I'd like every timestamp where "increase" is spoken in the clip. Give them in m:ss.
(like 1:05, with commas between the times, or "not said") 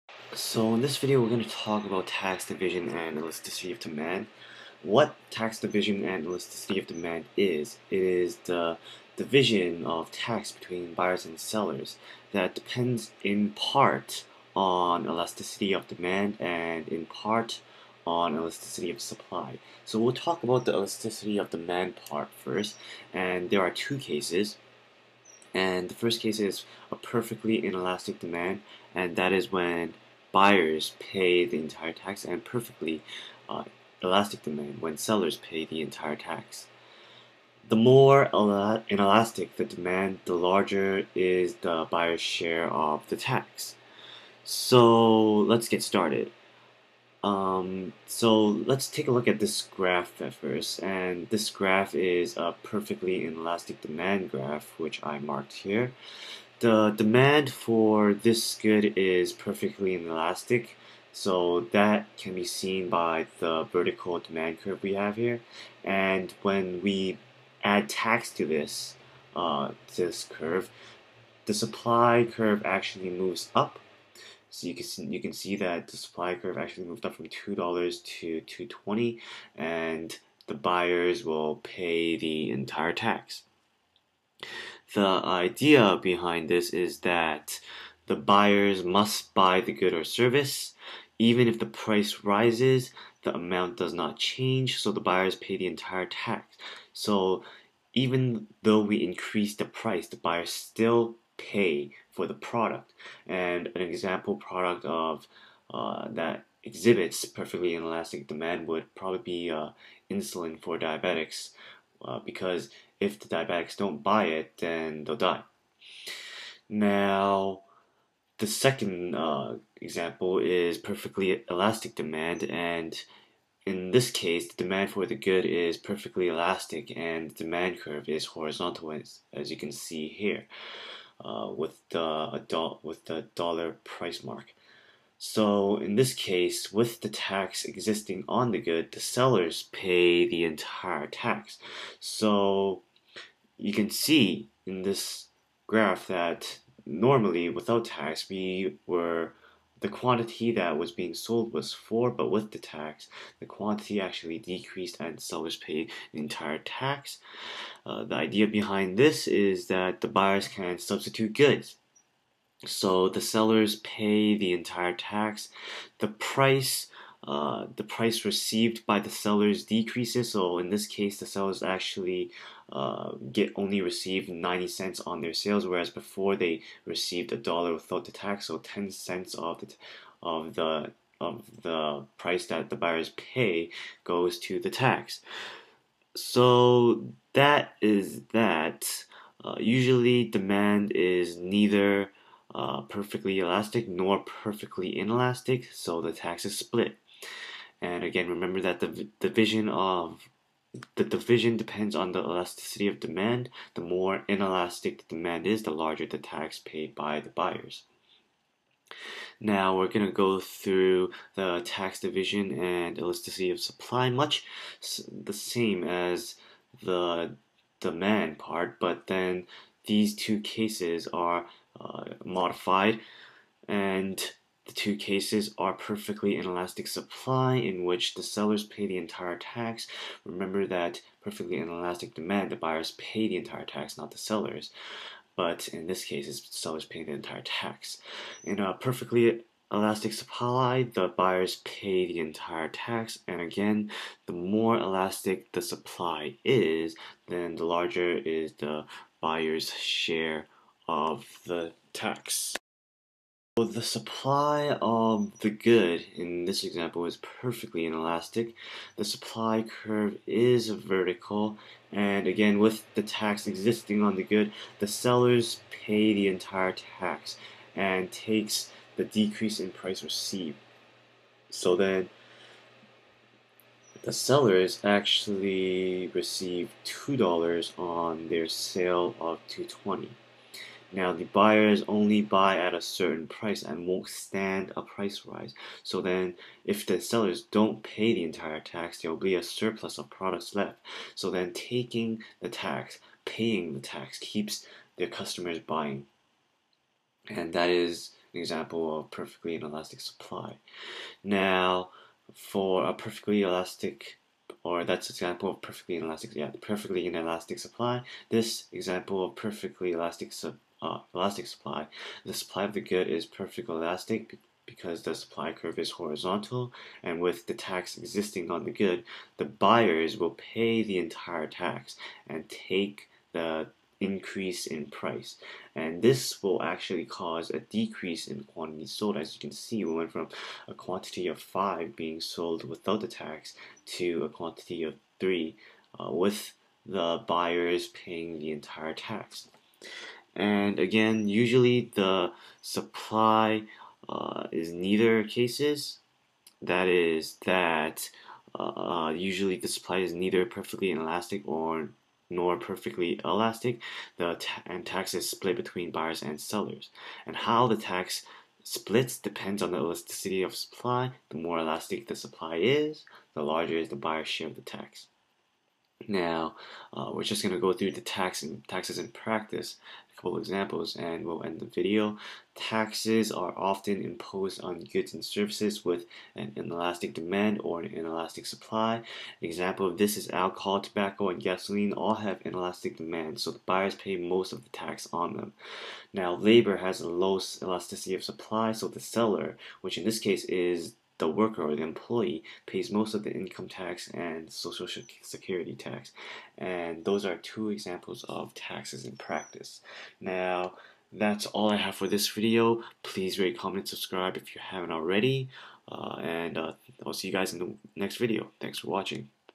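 1:39, 5:23.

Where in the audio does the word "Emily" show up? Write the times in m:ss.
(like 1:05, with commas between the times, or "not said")
not said.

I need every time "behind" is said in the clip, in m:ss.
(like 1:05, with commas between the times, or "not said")
1:26, 2:38.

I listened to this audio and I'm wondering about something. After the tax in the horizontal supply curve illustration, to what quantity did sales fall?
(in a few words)
3.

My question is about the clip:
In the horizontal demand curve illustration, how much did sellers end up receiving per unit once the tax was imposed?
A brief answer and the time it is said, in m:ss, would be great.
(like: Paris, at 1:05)
90 cents, at 2:54.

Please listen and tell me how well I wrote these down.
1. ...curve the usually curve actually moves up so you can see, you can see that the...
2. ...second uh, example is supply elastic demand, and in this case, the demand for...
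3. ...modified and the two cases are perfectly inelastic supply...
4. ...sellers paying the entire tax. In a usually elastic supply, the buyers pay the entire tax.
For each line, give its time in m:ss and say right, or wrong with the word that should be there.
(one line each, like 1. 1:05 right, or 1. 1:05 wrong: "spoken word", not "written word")
1. 1:10 wrong: "supply", not "usually"
2. 1:58 wrong: "perfectly", not "supply"
3. 3:42 right
4. 3:56 wrong: "perfectly", not "usually".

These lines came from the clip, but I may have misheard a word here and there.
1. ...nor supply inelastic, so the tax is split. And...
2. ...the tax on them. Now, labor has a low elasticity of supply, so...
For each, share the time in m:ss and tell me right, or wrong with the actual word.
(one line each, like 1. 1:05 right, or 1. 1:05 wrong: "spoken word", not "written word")
1. 3:13 wrong: "perfectly", not "supply"
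2. 6:24 right.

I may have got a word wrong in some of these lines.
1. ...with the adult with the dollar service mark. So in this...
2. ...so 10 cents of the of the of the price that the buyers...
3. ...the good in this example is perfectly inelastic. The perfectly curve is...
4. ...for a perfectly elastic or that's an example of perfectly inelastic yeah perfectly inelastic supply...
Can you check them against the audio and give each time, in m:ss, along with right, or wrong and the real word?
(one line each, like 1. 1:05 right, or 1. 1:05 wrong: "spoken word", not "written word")
1. 2:11 wrong: "price", not "service"
2. 2:58 right
3. 4:15 wrong: "supply", not "perfectly"
4. 5:02 right.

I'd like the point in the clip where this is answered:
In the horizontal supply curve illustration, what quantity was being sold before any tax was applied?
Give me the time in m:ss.
5:31.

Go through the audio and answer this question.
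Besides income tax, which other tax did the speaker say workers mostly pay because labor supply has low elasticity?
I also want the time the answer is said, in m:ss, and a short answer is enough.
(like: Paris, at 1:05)
social security tax, at 6:34.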